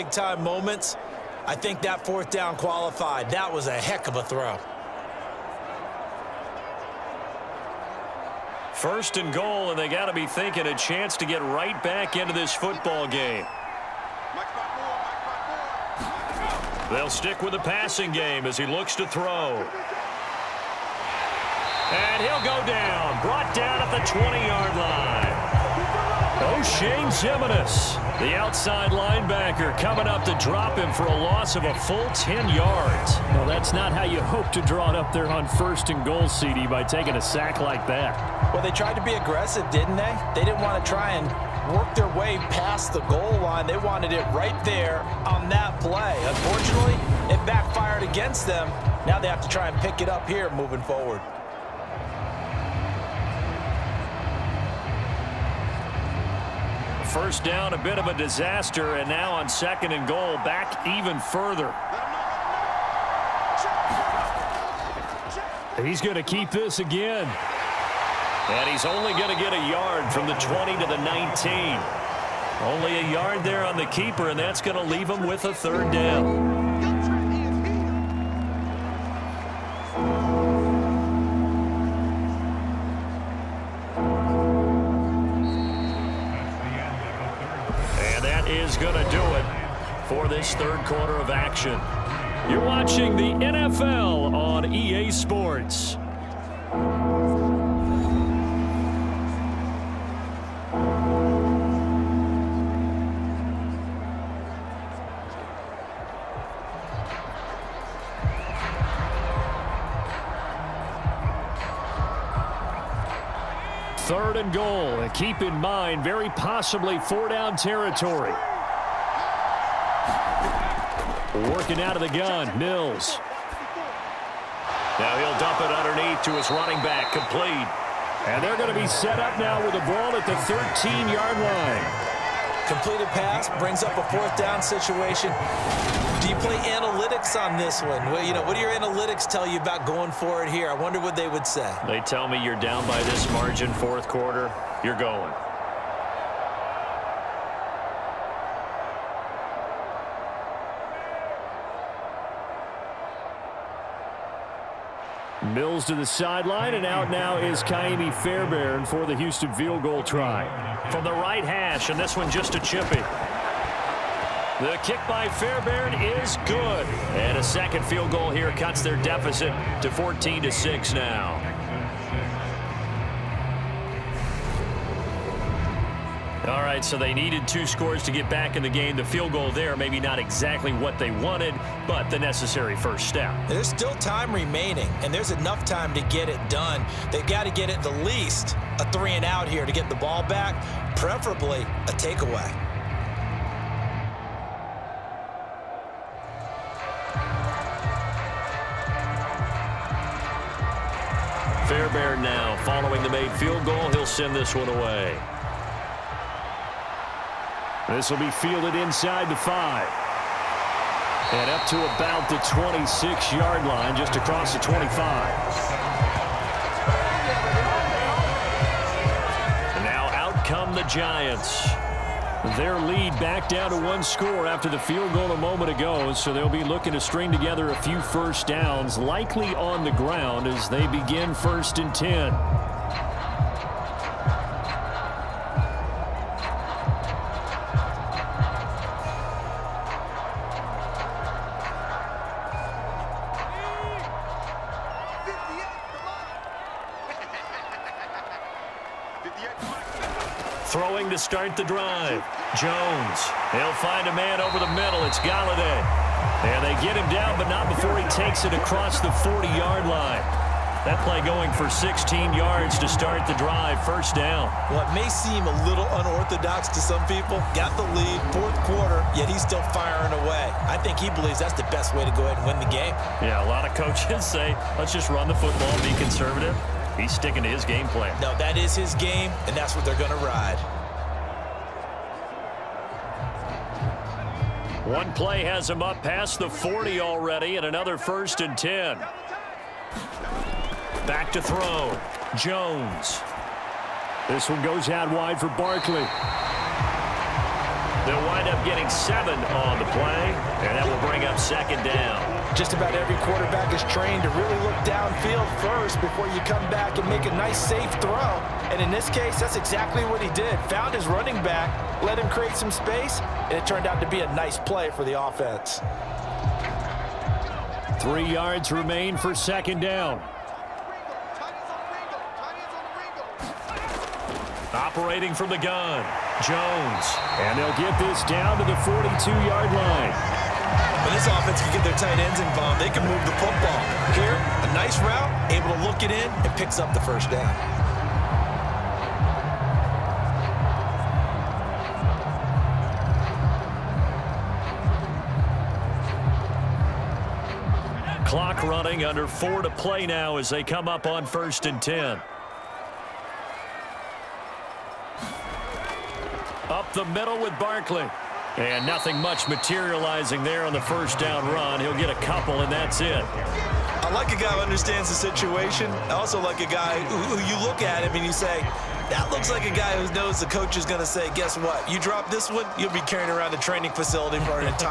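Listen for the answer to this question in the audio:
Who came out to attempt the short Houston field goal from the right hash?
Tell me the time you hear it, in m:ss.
2:37.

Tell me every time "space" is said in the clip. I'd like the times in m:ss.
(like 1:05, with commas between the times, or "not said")
5:12.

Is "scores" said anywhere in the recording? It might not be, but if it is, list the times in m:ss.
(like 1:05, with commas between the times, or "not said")
2:57, 3:44.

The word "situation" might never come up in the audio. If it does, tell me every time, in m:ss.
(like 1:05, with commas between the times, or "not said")
2:14, 6:05.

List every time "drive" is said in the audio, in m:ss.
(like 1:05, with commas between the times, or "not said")
4:11, 4:23.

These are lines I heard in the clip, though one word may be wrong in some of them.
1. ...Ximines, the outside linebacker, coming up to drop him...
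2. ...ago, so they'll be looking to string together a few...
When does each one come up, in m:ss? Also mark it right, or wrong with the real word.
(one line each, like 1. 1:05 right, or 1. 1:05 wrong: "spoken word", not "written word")
1. 0:27 right
2. 3:45 right.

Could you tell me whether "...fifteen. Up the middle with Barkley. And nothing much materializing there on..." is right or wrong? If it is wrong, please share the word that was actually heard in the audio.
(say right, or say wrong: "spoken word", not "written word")
wrong: "ten", not "fifteen".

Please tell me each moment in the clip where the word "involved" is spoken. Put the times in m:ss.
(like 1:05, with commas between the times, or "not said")
5:32.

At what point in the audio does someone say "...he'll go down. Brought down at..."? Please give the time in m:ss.
0:22.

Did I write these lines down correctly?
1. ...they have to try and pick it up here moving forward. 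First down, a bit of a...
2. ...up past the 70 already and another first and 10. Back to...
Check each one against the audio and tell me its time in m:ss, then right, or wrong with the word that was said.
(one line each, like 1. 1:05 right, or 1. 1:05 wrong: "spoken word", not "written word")
1. 0:49 right
2. 4:45 wrong: "40", not "70".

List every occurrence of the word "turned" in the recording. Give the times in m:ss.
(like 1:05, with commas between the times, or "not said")
5:13.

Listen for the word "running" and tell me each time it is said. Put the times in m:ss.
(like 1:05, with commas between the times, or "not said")
2:06, 5:11, 5:48.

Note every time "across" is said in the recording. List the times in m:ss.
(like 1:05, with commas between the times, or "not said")
3:34, 4:18.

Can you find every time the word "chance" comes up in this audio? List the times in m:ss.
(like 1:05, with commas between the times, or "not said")
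0:10.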